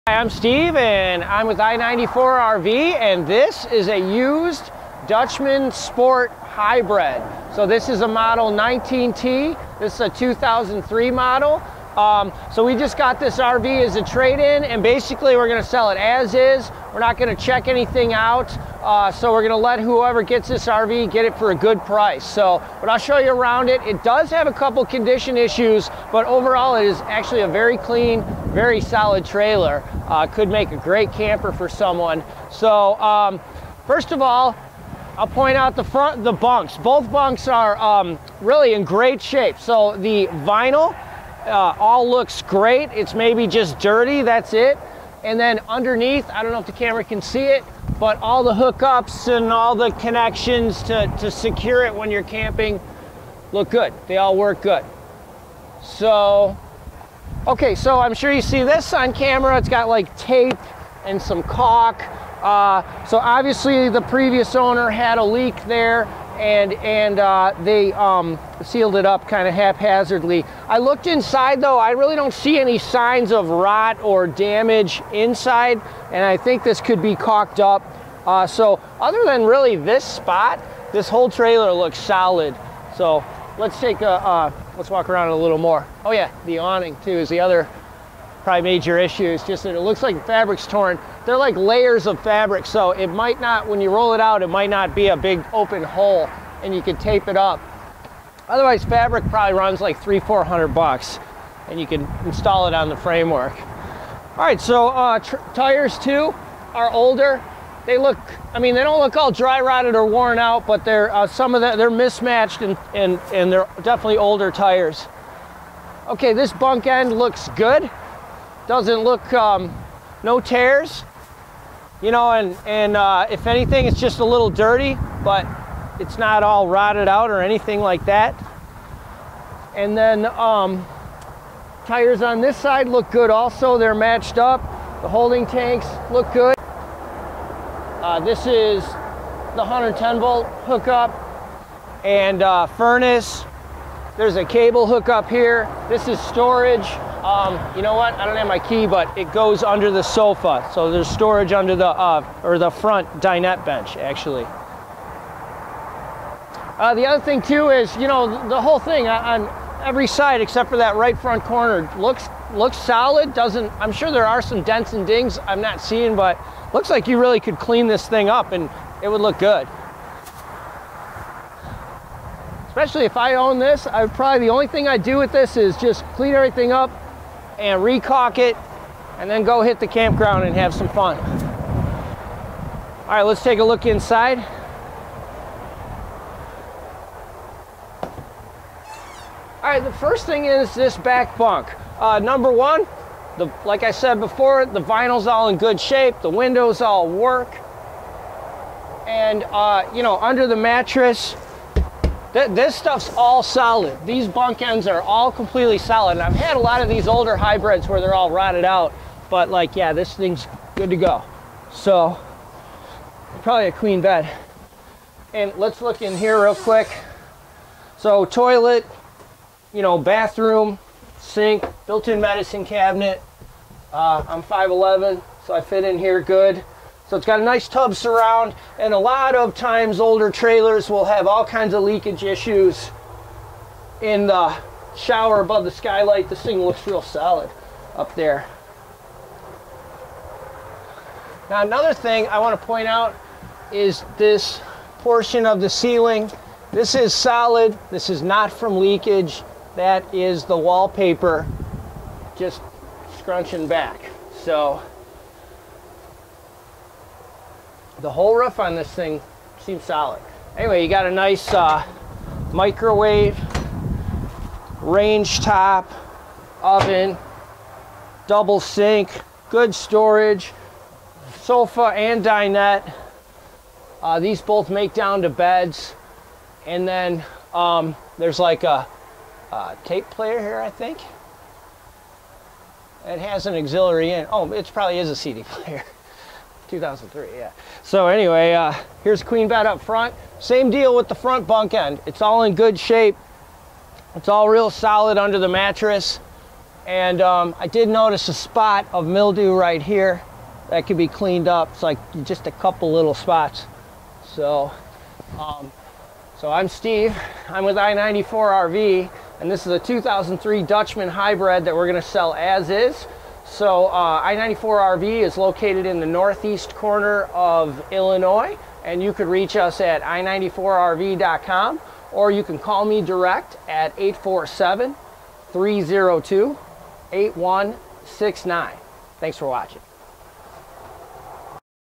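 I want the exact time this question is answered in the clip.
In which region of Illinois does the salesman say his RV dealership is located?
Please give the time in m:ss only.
5:16.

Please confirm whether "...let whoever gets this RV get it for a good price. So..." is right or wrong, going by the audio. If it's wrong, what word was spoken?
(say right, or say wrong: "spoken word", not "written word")
right.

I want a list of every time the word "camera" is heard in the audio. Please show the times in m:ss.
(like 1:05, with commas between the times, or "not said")
0:46, 0:59.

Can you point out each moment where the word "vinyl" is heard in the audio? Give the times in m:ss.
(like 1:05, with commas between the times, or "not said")
0:40, 3:14.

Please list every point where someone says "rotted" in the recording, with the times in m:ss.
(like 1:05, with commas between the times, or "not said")
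1:49, 2:06, 3:28.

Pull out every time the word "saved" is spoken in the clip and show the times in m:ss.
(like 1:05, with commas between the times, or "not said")
not said.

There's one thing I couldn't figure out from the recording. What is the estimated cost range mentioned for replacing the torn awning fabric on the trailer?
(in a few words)
$300-400.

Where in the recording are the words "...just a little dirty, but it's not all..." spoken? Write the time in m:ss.
2:03.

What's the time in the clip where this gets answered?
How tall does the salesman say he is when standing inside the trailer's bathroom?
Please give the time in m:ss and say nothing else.
3:44.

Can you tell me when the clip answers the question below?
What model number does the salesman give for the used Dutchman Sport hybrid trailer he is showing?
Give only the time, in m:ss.
0:08.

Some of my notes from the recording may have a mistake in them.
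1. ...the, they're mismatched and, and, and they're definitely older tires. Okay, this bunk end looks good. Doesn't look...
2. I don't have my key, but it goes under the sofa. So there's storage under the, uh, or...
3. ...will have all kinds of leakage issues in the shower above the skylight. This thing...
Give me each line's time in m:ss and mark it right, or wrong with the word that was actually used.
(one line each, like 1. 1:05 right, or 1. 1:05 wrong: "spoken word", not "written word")
1. 1:51 right
2. 2:28 right
3. 3:50 right.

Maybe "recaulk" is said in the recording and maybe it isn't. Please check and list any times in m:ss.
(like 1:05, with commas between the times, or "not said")
2:57.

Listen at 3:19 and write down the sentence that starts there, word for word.
And, uh, you know, under the mattress, Th this stuff's all solid.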